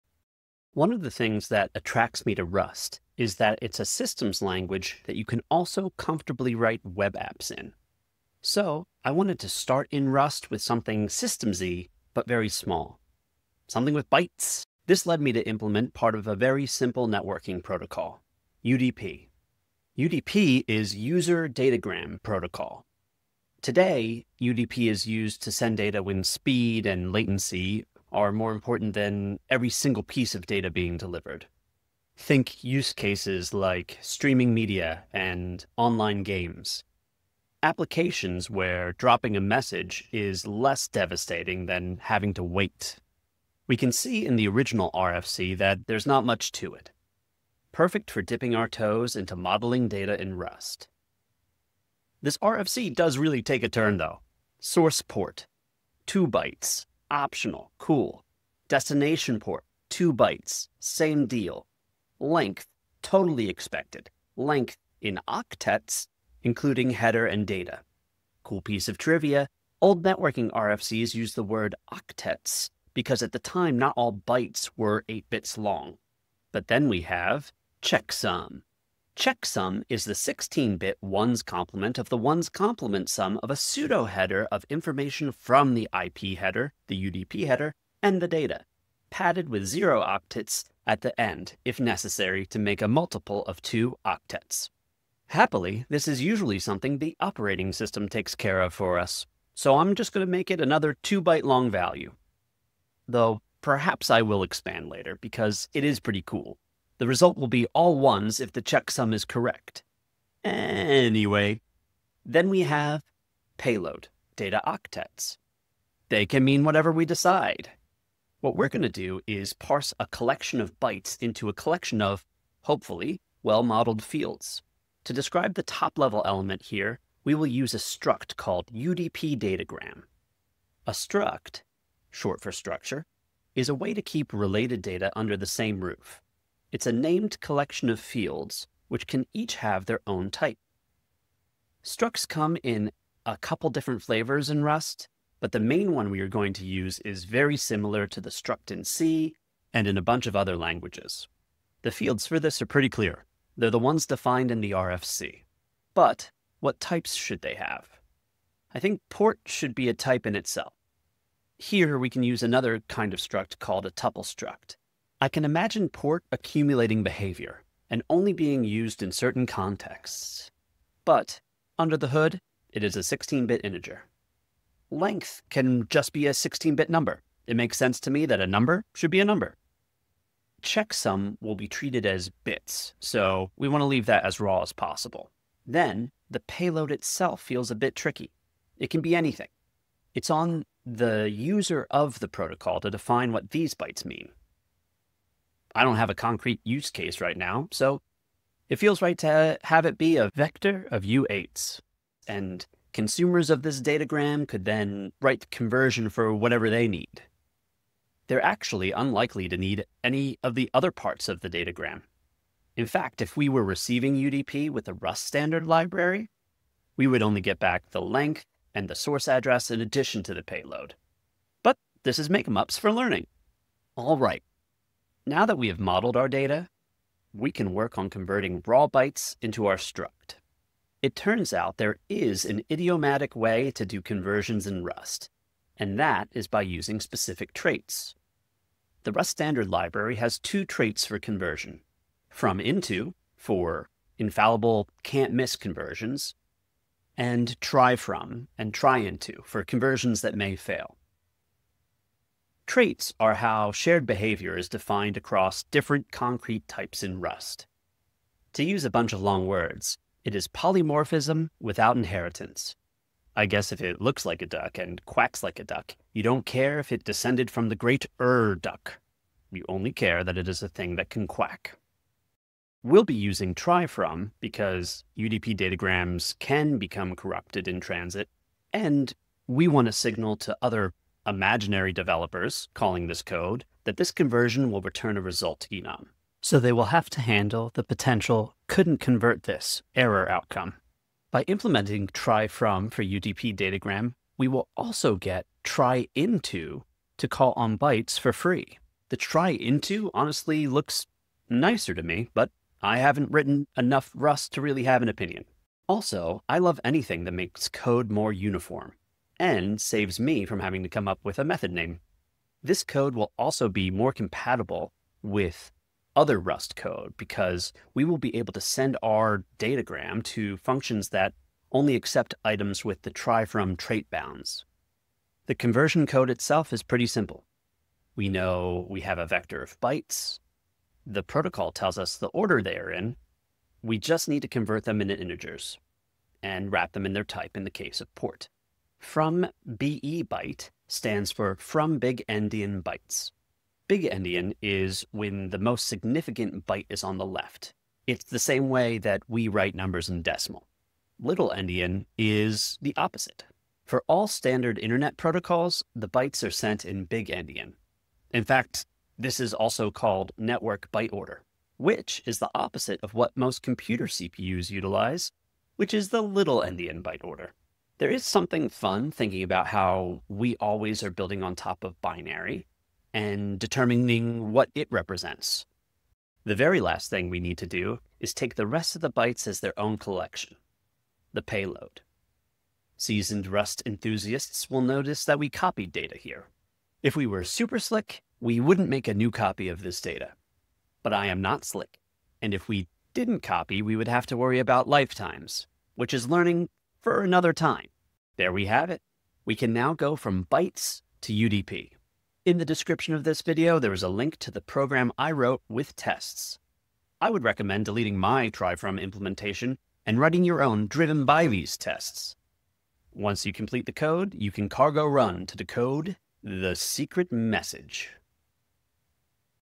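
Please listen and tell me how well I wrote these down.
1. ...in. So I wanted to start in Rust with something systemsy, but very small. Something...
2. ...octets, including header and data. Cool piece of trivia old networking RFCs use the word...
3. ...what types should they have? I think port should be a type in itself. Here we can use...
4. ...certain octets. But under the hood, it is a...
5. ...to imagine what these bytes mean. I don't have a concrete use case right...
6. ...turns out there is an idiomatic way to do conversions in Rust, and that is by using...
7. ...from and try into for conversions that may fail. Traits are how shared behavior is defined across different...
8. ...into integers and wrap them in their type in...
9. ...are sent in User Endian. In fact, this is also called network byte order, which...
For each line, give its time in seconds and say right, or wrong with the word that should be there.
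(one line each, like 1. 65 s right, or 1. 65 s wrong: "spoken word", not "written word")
1. 7 s right
2. 65 s right
3. 156 s right
4. 169 s wrong: "contexts", not "octets"
5. 192 s wrong: "define", not "imagine"
6. 231 s right
7. 247 s right
8. 335 s right
9. 356 s wrong: "Big", not "User".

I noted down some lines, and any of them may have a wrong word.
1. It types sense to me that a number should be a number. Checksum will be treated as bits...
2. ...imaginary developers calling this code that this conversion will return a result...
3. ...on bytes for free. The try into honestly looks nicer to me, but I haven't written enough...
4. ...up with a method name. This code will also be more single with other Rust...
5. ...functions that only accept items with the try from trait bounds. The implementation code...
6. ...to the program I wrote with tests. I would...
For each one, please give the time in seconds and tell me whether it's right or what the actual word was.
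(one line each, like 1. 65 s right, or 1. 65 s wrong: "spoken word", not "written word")
1. 177 s wrong: "makes", not "types"
2. 281 s right
3. 297 s right
4. 311 s wrong: "compatible", not "single"
5. 320 s wrong: "conversion", not "implementation"
6. 404 s right.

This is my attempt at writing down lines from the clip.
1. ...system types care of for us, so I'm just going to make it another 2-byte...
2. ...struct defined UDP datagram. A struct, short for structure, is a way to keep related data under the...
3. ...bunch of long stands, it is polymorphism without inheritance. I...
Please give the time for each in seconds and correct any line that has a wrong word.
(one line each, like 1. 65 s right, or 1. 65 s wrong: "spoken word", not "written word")
1. 97 s wrong: "takes", not "types"
2. 127 s wrong: "called", not "defined"
3. 258 s wrong: "words", not "stands".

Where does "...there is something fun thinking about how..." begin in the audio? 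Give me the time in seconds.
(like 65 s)
368 s.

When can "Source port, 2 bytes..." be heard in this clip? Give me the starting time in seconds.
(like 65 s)
54 s.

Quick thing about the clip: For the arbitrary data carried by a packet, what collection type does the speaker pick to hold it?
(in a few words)
vector of U8s.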